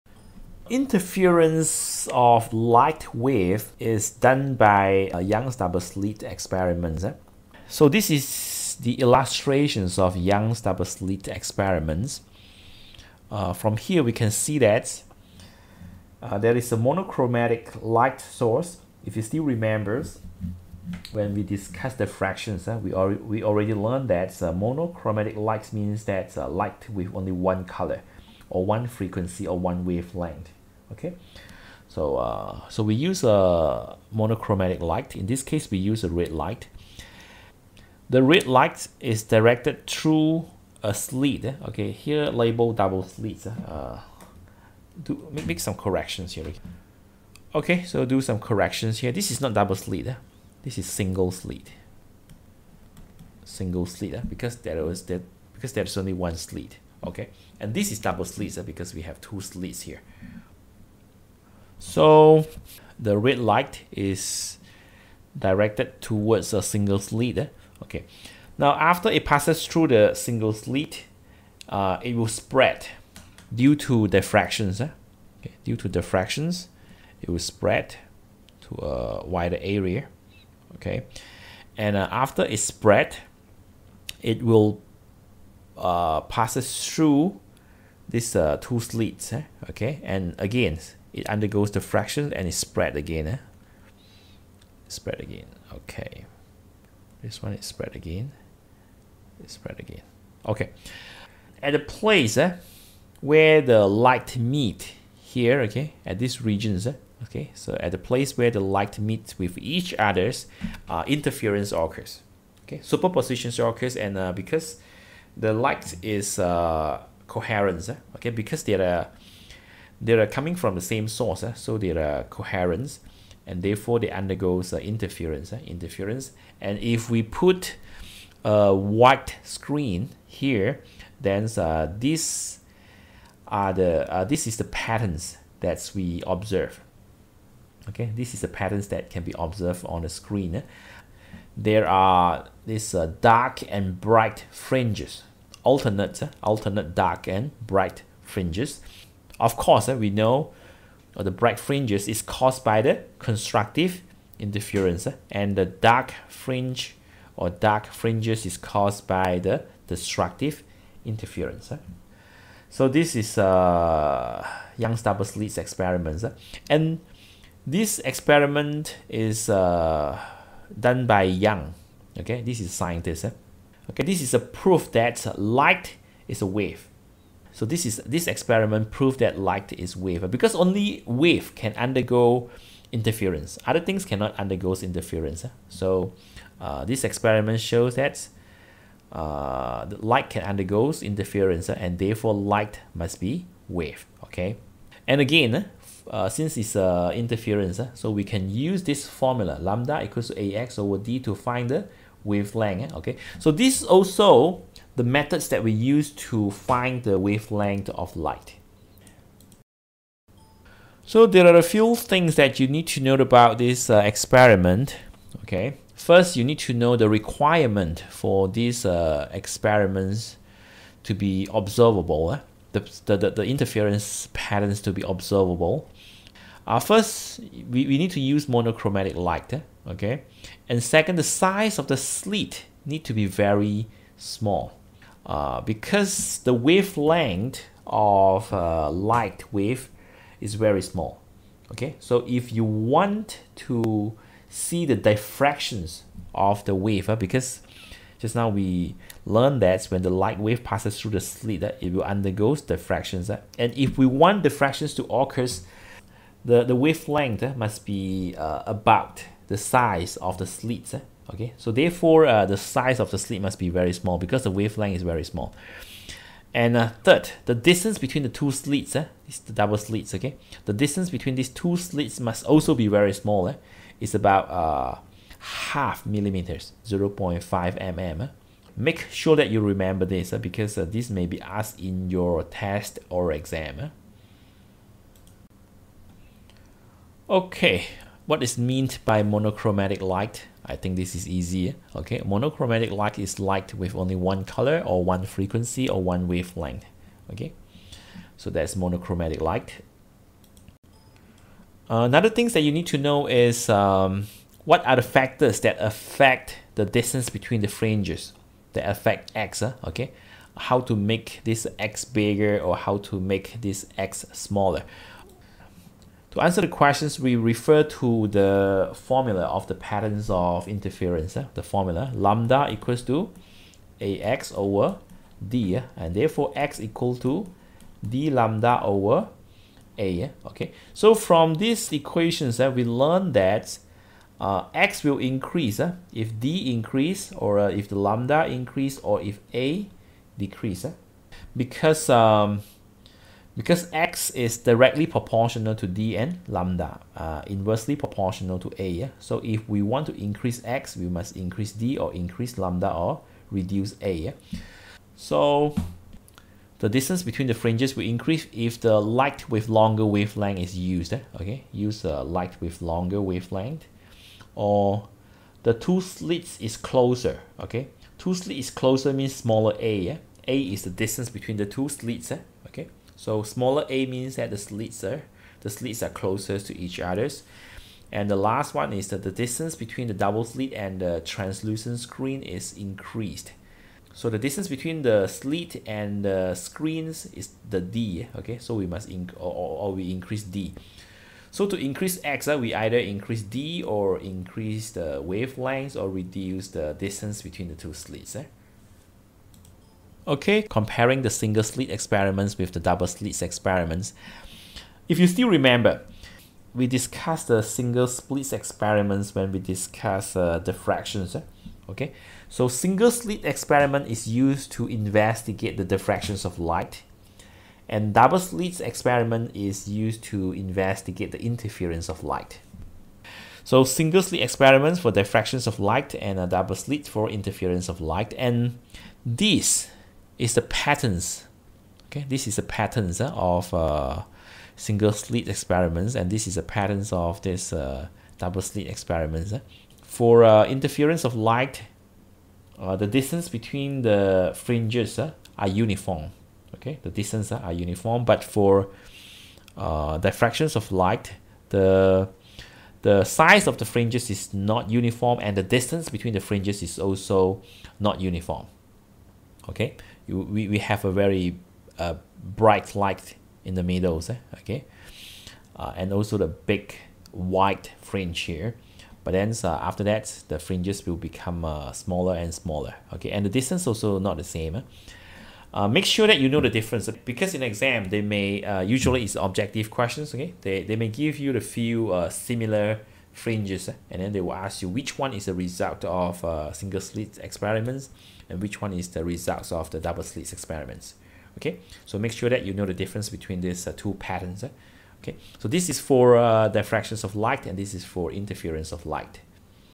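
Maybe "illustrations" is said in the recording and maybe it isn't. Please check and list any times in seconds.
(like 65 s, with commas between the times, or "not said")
8 s.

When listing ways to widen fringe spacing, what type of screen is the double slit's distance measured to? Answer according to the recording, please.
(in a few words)
Translucent screen.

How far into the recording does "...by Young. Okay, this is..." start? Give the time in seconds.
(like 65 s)
171 s.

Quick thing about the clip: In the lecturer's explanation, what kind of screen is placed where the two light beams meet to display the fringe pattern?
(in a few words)
White screen.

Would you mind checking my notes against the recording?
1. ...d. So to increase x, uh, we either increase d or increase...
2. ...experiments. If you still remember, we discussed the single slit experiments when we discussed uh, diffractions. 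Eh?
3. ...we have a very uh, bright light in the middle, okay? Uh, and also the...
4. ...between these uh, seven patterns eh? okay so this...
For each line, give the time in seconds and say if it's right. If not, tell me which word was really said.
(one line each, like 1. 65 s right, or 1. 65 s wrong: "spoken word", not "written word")
1. 390 s right
2. 403 s right
3. 460 s right
4. 493 s wrong: "two", not "seven".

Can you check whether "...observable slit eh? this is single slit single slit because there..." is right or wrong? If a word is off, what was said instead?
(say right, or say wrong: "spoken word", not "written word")
wrong: "double", not "observable".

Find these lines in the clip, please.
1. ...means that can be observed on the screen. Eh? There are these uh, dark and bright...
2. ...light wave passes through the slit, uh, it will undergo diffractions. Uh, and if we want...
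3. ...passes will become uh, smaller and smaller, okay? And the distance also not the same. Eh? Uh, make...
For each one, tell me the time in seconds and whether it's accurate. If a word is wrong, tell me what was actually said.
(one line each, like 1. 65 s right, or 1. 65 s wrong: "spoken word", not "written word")
1. 138 s wrong: "patterns", not "means"
2. 250 s right
3. 470 s wrong: "fringes", not "passes".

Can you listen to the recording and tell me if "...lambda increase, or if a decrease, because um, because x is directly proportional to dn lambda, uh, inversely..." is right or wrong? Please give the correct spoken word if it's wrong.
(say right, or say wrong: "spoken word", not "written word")
right.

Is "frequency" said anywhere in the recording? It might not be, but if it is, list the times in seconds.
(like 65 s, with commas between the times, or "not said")
28 s, 295 s.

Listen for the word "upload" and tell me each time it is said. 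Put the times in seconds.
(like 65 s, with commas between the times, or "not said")
not said.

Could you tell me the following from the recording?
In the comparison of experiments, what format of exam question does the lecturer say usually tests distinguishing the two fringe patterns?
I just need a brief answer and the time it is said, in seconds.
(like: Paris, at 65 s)
Objective questions, at 479 s.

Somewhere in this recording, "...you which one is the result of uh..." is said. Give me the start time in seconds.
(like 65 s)
484 s.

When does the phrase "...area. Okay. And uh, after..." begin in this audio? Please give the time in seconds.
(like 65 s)
79 s.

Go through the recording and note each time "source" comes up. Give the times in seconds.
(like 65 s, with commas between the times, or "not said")
18 s, 121 s.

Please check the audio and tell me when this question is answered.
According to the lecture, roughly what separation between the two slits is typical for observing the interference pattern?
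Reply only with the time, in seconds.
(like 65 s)
276 s.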